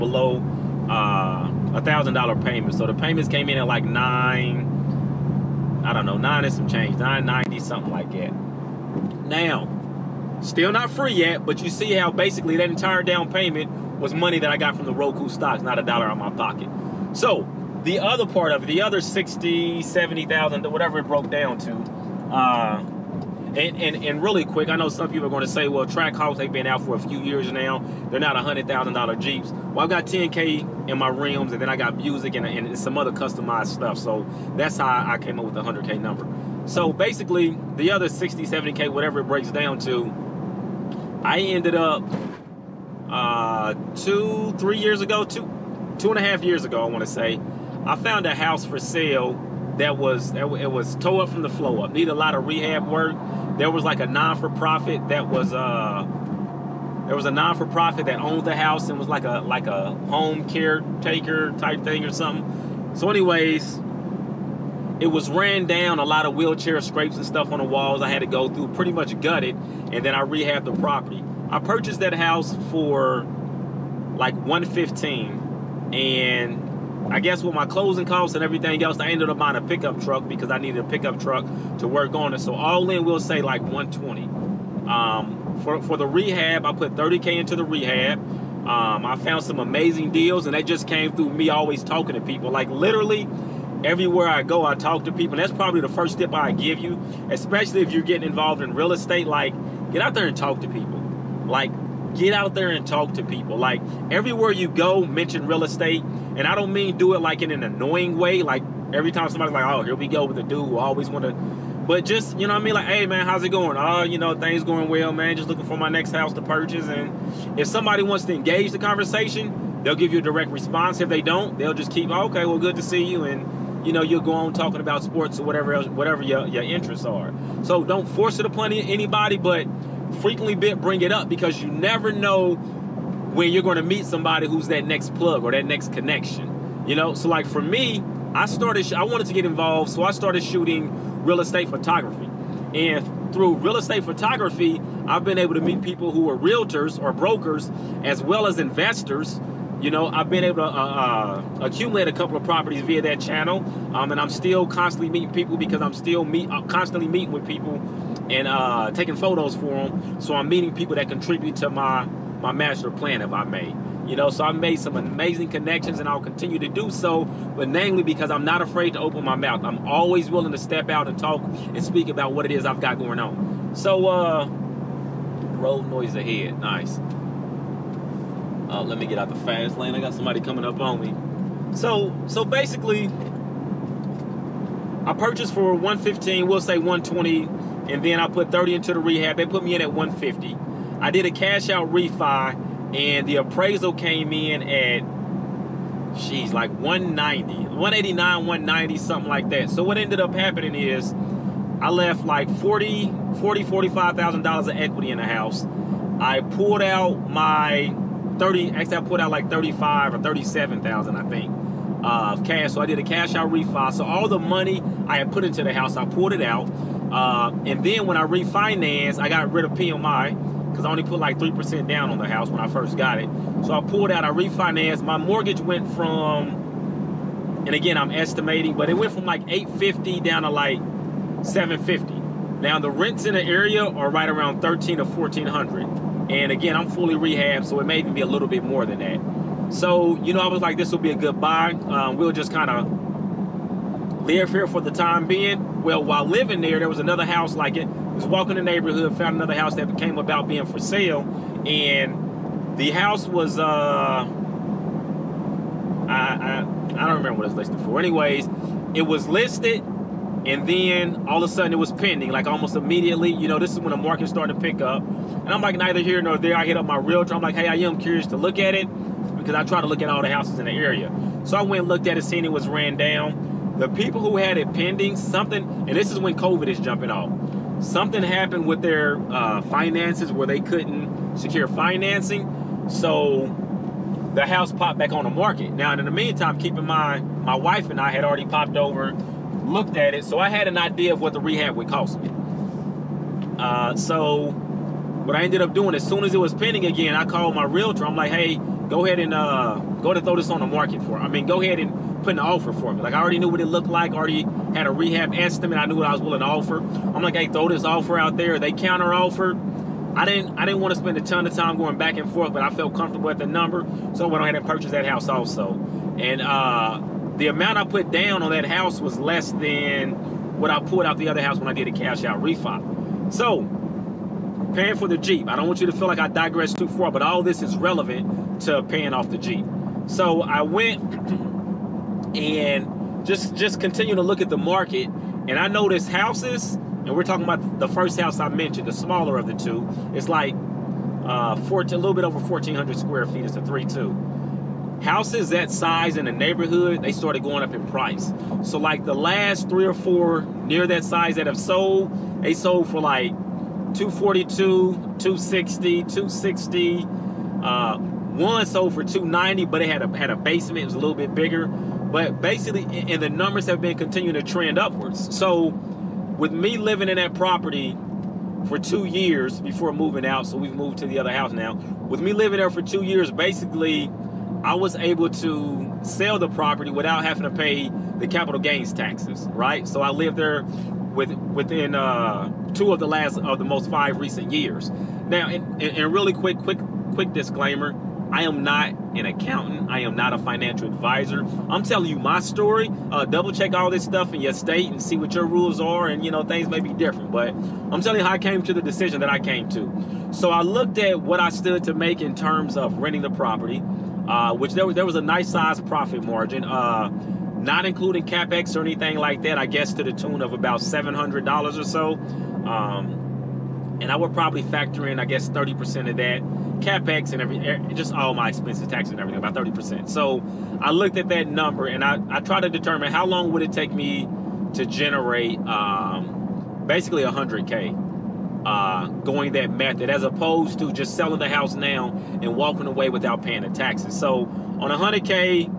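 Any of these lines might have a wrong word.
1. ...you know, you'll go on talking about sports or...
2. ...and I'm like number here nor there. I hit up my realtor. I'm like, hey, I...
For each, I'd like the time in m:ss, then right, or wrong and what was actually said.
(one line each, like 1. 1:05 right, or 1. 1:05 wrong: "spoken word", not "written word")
1. 2:03 right
2. 4:25 wrong: "neither", not "number".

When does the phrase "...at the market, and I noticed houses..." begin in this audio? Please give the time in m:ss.
5:34.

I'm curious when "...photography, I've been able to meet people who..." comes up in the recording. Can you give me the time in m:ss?
2:24.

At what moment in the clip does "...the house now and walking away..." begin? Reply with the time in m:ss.
7:11.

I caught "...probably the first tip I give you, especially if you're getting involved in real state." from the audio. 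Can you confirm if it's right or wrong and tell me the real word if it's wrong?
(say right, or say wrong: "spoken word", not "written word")
wrong: "estate", not "state".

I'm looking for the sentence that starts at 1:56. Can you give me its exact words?
And if somebody wants to engage the conversation, they'll give you a direct response.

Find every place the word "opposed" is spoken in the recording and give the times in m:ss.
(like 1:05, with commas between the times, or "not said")
7:10.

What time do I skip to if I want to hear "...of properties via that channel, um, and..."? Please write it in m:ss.
2:32.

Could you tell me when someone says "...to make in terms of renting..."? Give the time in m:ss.
6:41.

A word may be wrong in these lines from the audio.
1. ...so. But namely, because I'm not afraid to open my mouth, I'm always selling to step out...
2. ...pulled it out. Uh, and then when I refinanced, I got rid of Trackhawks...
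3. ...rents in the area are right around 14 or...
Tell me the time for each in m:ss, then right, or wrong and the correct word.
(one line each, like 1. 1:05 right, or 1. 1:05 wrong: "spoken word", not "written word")
1. 2:46 wrong: "willing", not "selling"
2. 3:36 wrong: "PMI", not "Trackhawks"
3. 3:52 wrong: "13", not "14".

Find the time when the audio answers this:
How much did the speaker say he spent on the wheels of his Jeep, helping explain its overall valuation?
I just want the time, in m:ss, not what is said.
0:30.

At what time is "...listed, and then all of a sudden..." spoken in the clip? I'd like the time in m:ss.
4:19.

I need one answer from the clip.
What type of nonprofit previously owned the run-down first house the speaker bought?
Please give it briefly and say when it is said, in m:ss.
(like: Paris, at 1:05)
home caretaker, at 1:00.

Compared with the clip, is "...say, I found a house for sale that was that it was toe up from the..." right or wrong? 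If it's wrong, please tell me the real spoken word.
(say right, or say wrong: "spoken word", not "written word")
right.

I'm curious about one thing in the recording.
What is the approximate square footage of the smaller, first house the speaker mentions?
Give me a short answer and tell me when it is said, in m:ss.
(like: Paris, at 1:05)
1,400 square feet, at 5:42.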